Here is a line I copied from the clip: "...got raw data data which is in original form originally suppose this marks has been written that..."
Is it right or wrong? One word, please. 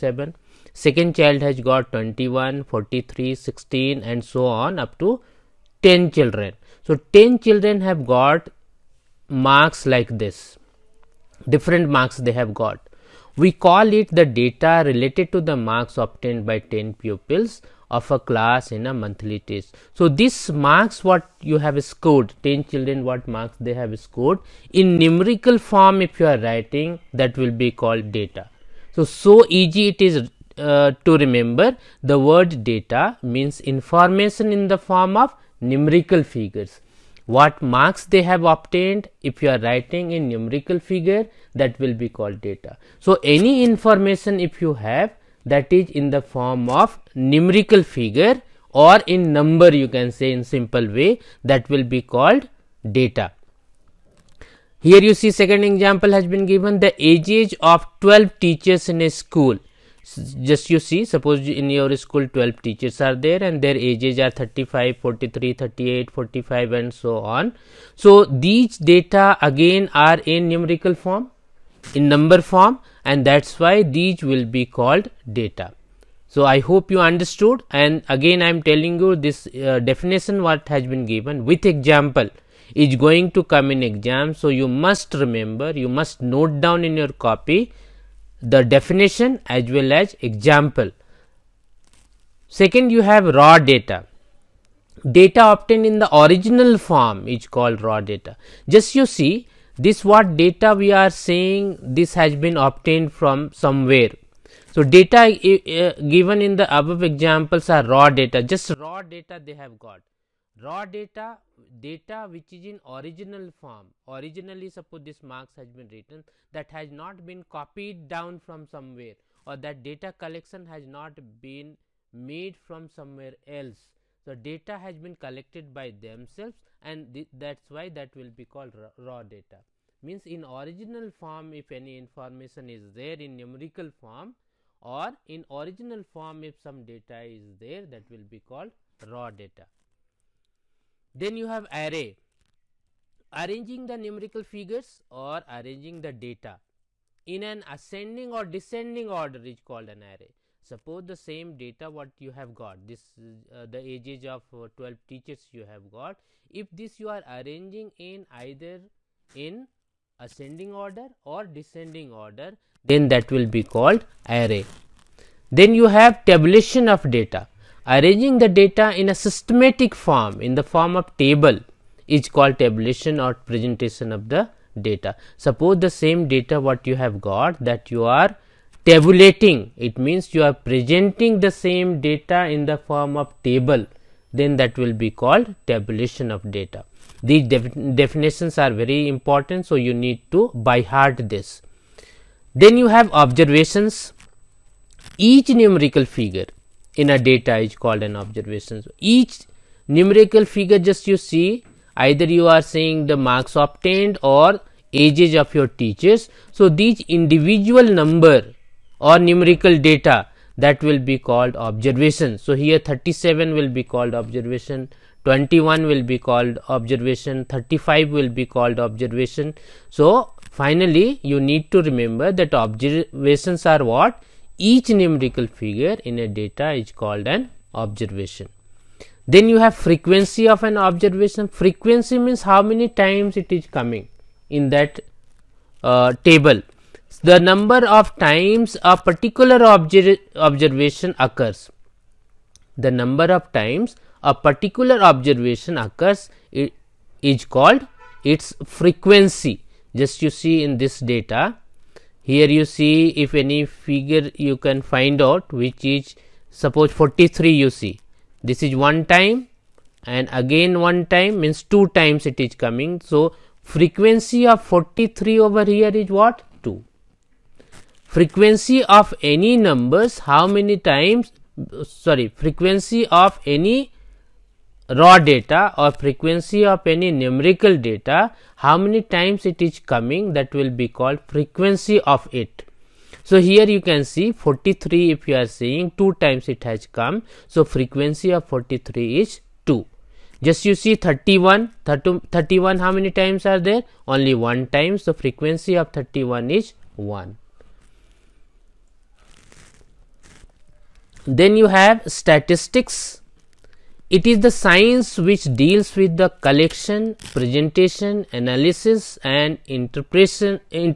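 right.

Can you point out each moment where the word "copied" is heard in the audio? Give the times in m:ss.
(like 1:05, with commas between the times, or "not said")
1:57.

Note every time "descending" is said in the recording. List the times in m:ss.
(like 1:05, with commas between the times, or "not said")
2:28, 2:41.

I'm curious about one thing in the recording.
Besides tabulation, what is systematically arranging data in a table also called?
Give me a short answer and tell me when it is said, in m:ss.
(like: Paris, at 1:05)
Presentation of the data, at 2:53.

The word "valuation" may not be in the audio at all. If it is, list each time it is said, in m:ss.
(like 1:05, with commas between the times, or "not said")
not said.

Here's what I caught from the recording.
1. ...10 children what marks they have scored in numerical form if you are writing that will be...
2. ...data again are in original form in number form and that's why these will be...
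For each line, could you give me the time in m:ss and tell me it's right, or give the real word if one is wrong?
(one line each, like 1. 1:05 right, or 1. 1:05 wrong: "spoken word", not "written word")
1. 0:22 right
2. 1:08 wrong: "numerical", not "original".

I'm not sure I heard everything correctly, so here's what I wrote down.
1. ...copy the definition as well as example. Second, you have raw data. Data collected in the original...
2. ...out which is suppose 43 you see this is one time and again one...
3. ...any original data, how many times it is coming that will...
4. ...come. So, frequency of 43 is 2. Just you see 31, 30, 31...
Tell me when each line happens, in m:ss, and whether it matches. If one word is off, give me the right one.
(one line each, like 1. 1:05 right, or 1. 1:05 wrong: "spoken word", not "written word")
1. 1:27 wrong: "obtained", not "collected"
2. 4:15 right
3. 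4:36 wrong: "numerical", not "original"
4. 4:46 right.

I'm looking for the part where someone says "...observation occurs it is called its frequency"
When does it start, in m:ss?
4:05.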